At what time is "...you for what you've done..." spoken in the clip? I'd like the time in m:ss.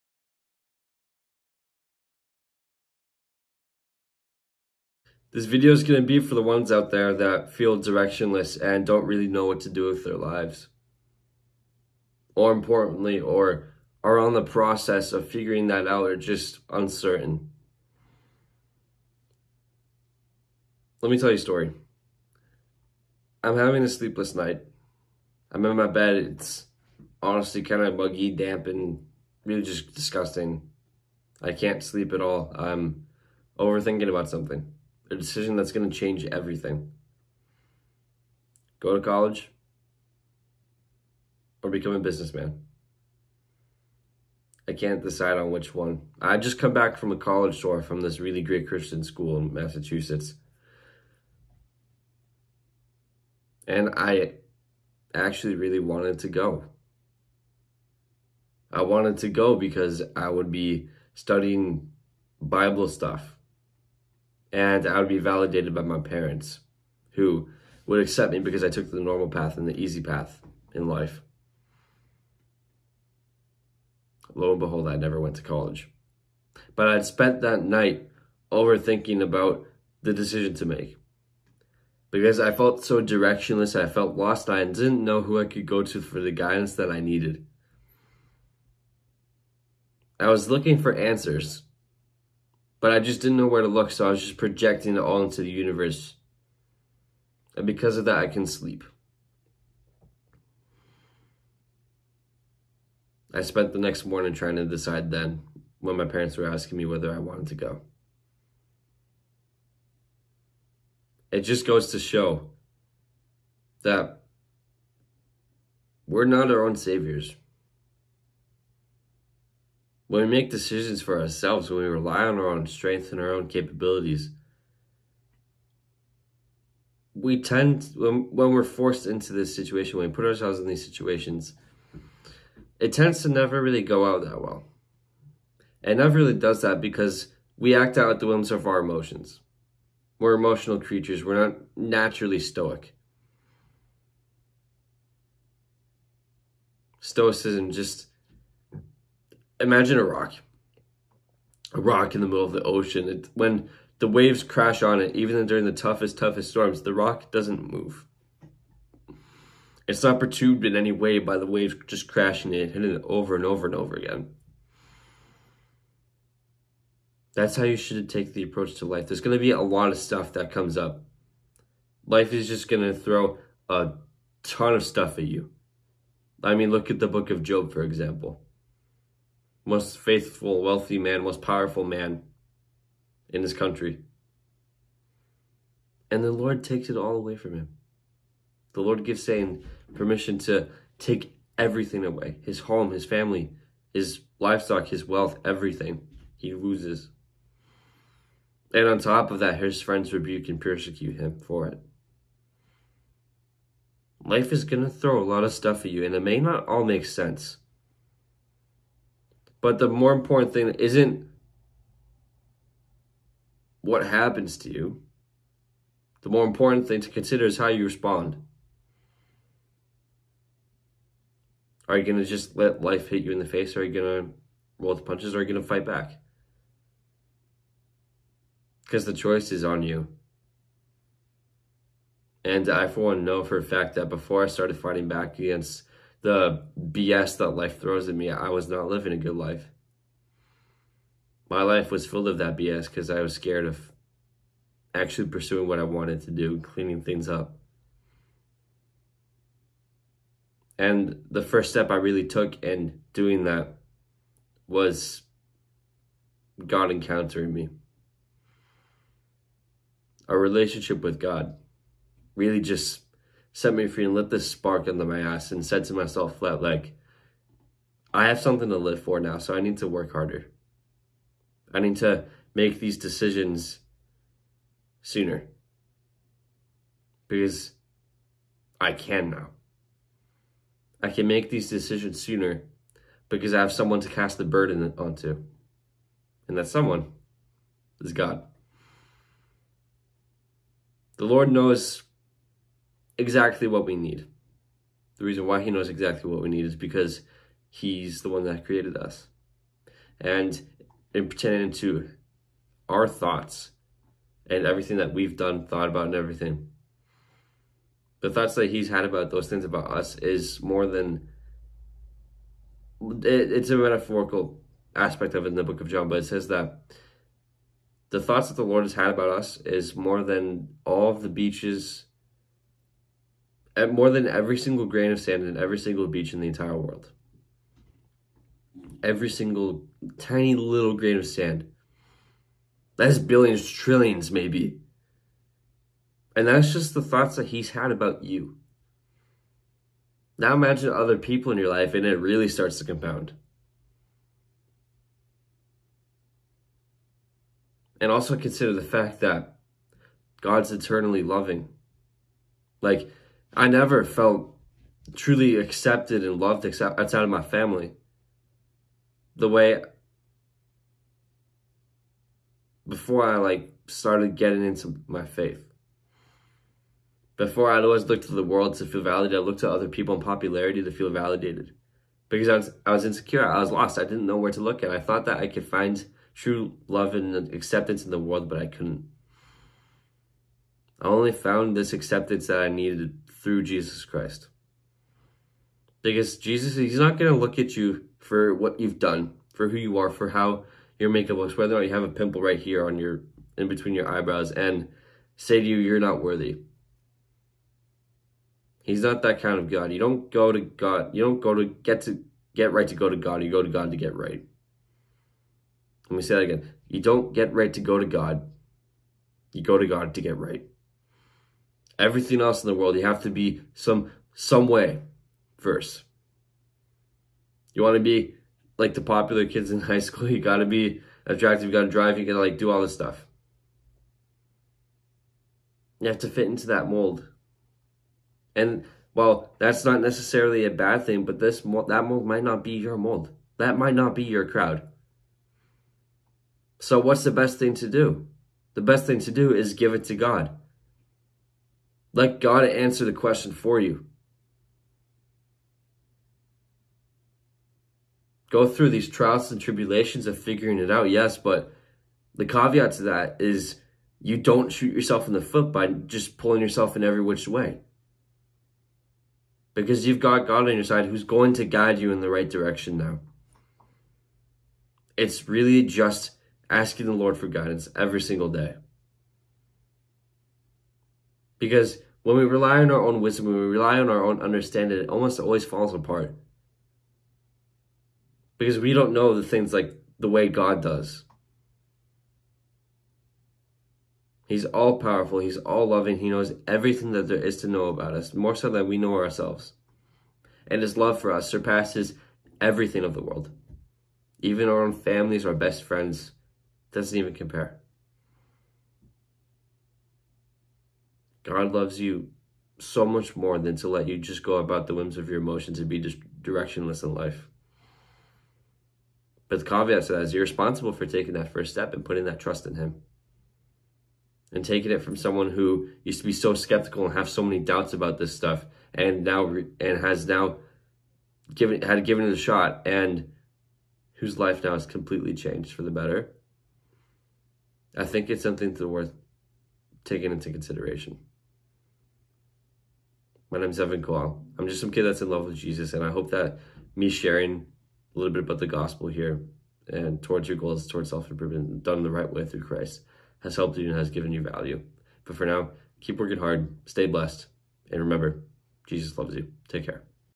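6:27.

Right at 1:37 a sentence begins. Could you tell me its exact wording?
And because of that, I can sleep.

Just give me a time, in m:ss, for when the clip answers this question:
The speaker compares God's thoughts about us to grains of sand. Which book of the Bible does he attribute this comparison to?
5:15.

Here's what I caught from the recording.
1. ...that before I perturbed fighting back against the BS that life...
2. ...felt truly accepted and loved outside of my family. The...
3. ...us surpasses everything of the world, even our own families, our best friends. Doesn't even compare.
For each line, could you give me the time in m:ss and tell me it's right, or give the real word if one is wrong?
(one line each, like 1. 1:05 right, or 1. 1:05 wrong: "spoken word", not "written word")
1. 3:53 wrong: "started", not "perturbed"
2. 5:54 right
3. 8:11 right.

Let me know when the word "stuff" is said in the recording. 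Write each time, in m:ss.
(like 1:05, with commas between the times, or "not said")
1:02, 2:49, 2:54, 3:25, 7:02, 8:38.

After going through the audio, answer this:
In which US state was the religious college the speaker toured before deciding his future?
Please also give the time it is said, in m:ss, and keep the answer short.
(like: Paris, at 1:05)
Massachusetts, at 0:49.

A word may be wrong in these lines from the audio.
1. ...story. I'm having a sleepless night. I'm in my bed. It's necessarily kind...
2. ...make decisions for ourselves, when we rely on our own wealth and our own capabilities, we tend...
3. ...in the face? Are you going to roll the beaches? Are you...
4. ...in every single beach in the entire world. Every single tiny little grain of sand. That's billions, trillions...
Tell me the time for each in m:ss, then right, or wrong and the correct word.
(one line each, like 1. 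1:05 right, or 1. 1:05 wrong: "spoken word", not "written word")
1. 0:21 wrong: "honestly", not "necessarily"
2. 2:00 wrong: "strength", not "wealth"
3. 3:43 wrong: "punches", not "beaches"
4. 5:25 right.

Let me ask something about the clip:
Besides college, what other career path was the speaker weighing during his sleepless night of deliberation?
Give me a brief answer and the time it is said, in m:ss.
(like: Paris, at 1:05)
businessman, at 0:41.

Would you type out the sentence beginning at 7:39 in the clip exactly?
Because you've got God on your side who's going to guide you in the right direction now.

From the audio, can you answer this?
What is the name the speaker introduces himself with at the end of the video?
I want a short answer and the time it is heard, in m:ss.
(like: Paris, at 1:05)
Evan Cole, at 8:53.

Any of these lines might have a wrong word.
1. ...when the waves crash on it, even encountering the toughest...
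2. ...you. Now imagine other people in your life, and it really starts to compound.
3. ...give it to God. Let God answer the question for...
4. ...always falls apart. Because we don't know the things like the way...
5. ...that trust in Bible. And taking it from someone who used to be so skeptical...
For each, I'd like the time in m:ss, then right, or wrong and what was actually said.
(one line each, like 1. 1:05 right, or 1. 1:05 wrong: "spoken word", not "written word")
1. 2:33 wrong: "during", not "encountering"
2. 5:38 right
3. 7:19 right
4. 7:55 right
5. 8:32 wrong: "Him", not "Bible".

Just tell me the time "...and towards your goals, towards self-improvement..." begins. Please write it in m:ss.
8:59.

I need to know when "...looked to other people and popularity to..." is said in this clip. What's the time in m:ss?
6:09.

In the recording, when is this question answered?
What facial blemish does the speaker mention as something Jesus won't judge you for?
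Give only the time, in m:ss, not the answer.
6:32.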